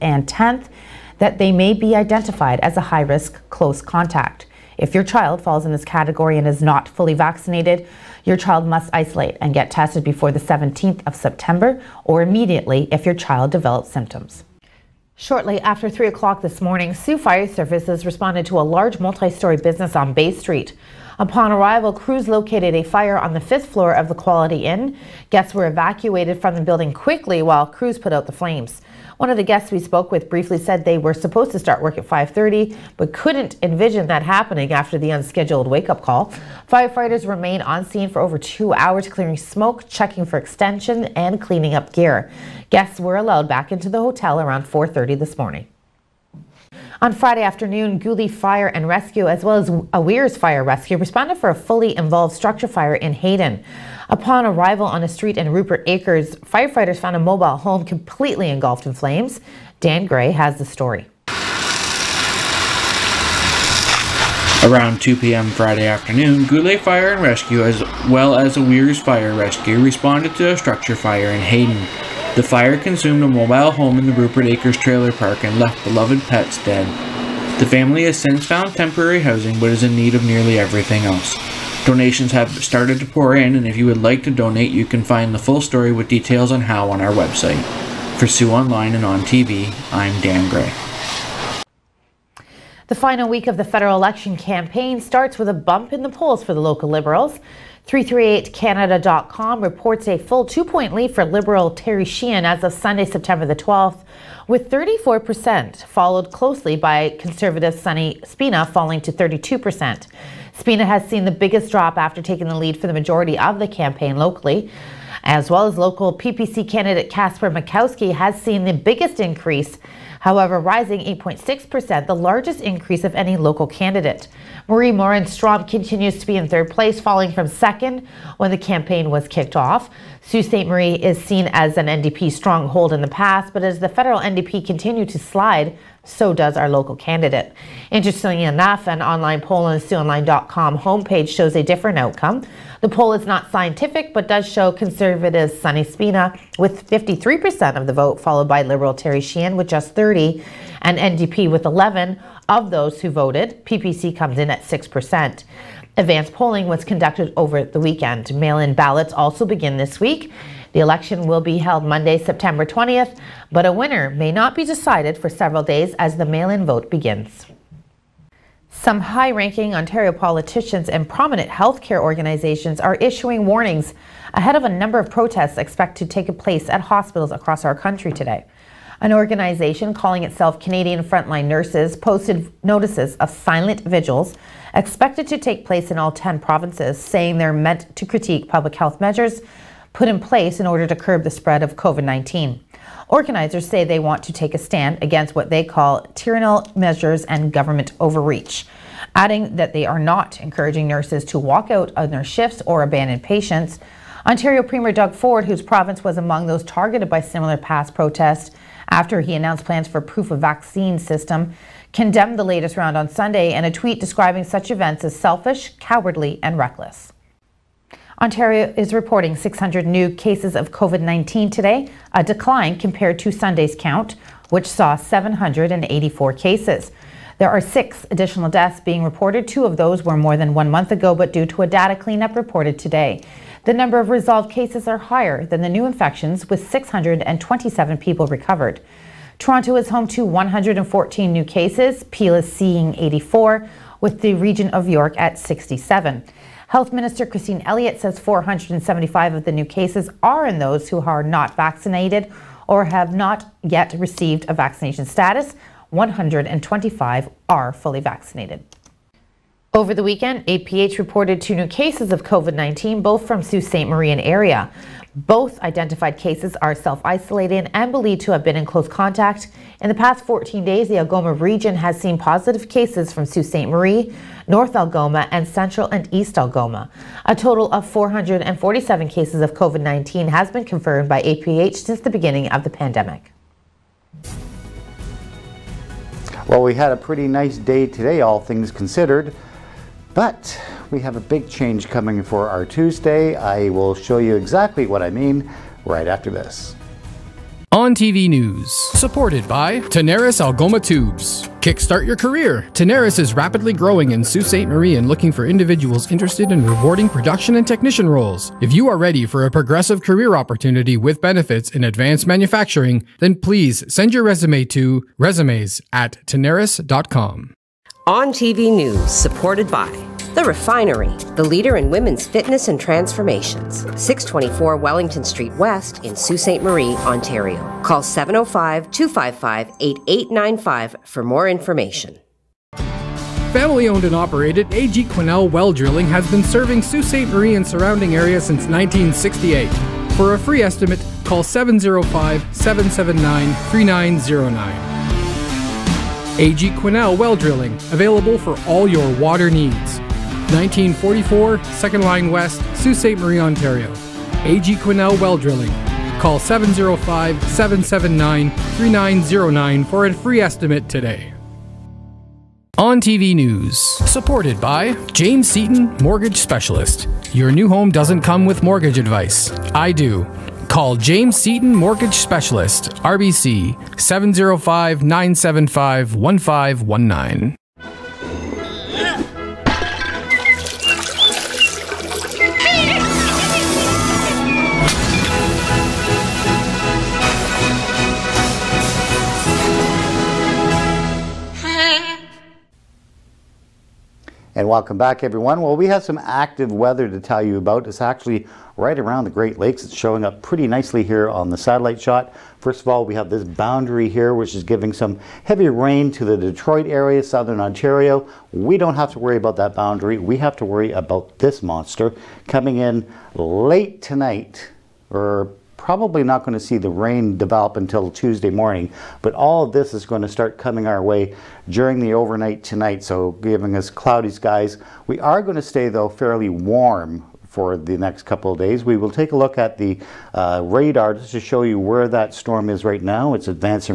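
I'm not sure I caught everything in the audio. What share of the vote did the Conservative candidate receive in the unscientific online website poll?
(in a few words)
53%.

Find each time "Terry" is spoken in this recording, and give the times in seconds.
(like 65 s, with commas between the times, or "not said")
101 s, 148 s.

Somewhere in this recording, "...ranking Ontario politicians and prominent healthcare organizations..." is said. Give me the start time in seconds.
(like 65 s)
169 s.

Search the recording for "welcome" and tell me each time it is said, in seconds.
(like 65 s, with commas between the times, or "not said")
394 s.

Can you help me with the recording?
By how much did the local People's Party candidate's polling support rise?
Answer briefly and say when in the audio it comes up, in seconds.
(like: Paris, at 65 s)
8.6%, at 121 s.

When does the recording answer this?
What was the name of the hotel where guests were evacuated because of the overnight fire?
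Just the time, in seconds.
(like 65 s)
24 s.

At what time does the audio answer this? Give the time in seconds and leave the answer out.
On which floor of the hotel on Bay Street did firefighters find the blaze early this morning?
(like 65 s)
23 s.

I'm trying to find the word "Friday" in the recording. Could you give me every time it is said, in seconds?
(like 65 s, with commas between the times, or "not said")
47 s, 65 s.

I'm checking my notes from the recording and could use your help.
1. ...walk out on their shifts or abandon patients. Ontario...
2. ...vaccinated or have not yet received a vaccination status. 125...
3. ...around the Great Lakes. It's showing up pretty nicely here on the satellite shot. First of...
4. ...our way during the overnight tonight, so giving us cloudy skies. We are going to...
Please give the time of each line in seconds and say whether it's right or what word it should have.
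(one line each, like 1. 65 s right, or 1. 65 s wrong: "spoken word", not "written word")
1. 201 s right
2. 251 s right
3. 398 s right
4. 420 s right.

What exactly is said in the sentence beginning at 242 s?
Peel is seeing 84, with the region of York at 67.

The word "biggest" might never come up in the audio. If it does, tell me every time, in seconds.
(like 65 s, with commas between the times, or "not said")
111 s, 118 s.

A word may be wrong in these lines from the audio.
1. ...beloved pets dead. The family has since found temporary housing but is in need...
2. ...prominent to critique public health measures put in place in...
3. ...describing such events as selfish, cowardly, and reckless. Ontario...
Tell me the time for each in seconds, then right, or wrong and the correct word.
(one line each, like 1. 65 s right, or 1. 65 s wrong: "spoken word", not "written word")
1. 75 s right
2. 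187 s wrong: "meant", not "prominent"
3. 213 s right.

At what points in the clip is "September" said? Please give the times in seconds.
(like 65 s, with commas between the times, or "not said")
11 s, 103 s, 162 s.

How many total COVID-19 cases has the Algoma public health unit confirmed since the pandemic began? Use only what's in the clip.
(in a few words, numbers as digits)
447.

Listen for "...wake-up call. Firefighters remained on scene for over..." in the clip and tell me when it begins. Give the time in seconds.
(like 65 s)
35 s.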